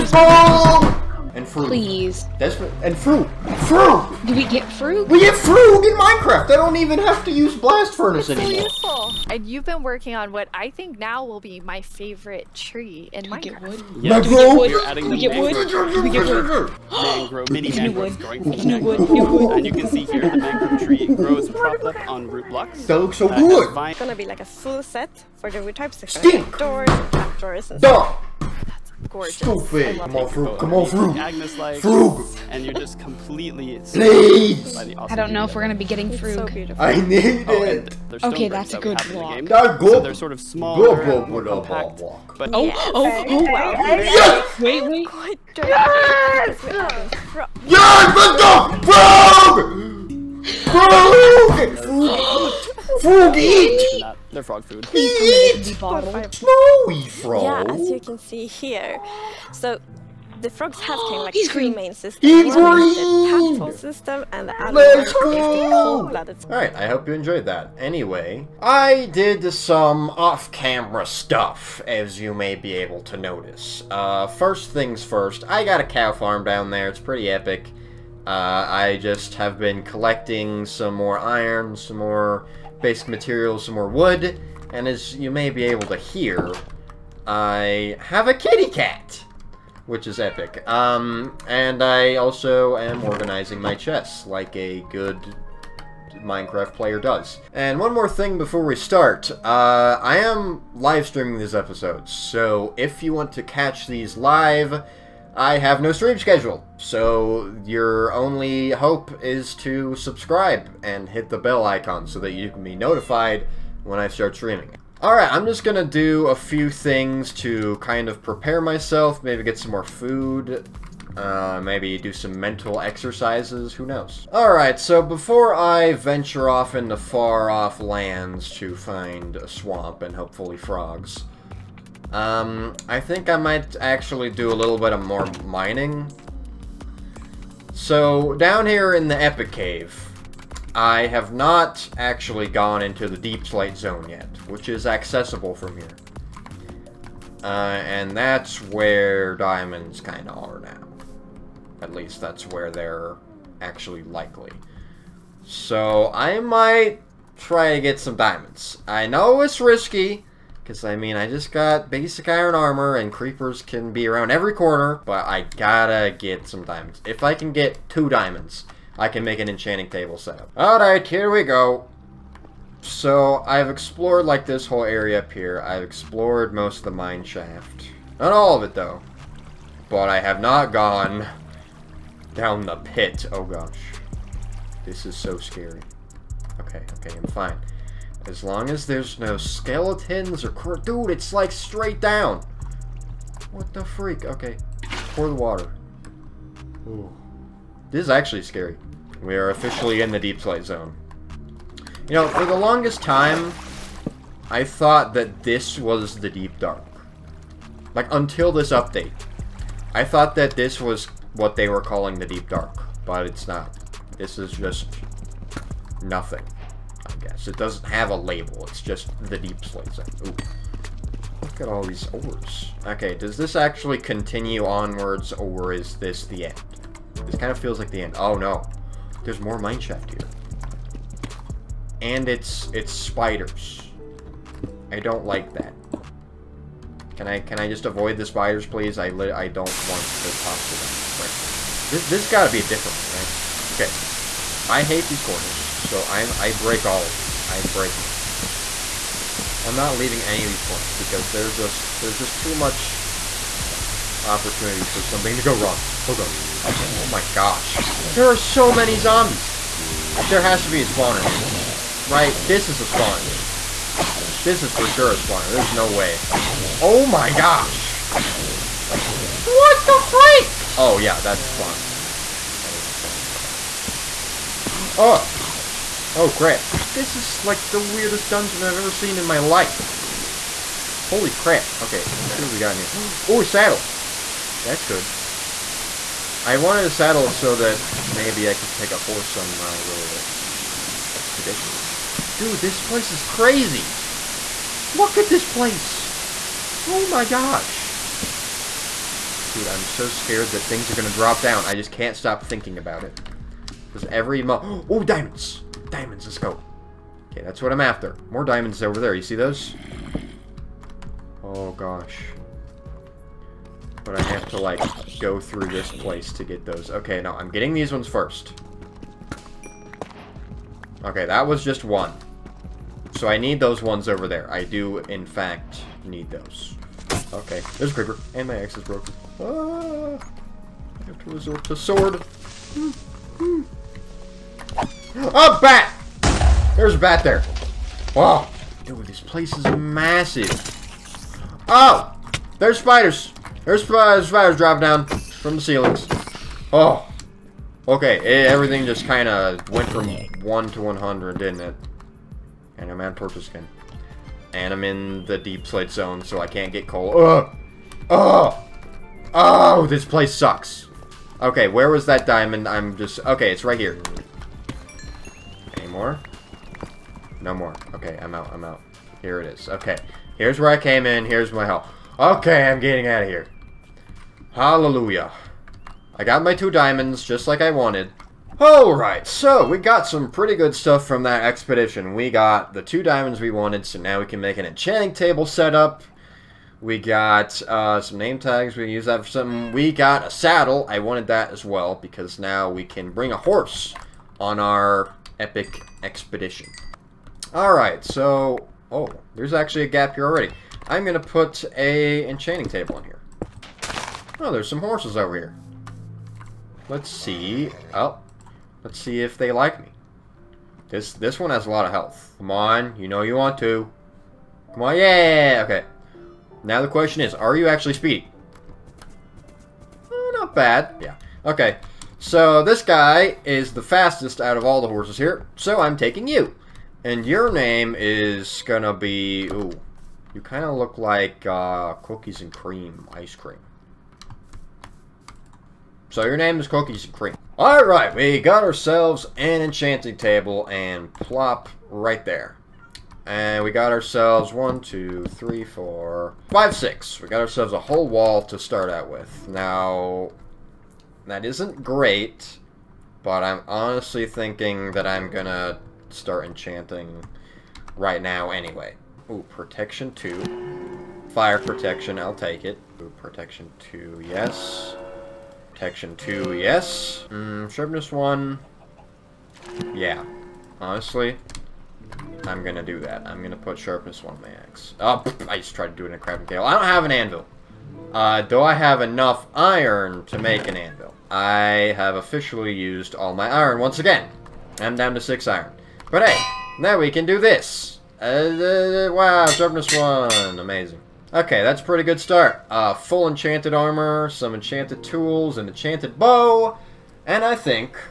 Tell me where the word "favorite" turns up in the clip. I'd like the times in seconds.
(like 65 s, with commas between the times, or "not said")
11 s.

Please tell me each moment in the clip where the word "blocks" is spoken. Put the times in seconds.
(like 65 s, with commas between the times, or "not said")
22 s.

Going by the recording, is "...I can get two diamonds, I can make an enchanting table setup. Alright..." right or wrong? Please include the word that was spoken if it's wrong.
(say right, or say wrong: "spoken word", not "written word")
right.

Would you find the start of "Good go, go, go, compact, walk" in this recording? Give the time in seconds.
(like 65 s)
40 s.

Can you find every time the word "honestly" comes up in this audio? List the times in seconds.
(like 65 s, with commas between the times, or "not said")
453 s, 470 s.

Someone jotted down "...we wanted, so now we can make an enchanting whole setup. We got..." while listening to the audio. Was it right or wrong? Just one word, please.
wrong.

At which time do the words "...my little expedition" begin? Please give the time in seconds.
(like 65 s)
289 s.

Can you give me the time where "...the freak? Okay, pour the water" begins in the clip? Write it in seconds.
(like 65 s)
193 s.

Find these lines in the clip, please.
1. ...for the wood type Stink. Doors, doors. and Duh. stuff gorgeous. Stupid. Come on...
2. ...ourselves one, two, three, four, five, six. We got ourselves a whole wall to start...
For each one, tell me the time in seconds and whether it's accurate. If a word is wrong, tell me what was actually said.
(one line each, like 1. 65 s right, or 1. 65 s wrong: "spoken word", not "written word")
1. 25 s right
2. 443 s right.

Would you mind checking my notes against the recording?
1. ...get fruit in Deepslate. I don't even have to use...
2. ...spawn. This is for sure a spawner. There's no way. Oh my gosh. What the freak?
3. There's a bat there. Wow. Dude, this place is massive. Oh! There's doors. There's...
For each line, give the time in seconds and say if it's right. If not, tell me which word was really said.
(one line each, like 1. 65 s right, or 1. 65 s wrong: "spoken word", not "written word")
1. 5 s wrong: "Minecraft", not "Deepslate"
2. 262 s right
3. 336 s wrong: "spiders", not "doors".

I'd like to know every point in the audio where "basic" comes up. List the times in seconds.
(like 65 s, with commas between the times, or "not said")
82 s, 161 s.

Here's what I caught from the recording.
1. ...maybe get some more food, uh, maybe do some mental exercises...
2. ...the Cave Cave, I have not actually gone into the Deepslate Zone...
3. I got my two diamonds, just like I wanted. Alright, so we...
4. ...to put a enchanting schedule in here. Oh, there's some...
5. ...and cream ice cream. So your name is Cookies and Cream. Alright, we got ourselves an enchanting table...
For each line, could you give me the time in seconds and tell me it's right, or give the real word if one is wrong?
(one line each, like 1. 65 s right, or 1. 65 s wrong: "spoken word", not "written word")
1. 119 s right
2. 139 s wrong: "Epic", not "Cave"
3. 376 s right
4. 401 s wrong: "table", not "schedule"
5. 432 s right.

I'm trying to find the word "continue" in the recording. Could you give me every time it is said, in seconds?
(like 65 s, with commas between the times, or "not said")
223 s.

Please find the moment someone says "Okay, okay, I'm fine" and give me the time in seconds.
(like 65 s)
186 s.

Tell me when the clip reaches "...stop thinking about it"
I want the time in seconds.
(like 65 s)
302 s.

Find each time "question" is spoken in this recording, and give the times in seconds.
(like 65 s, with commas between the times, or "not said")
416 s.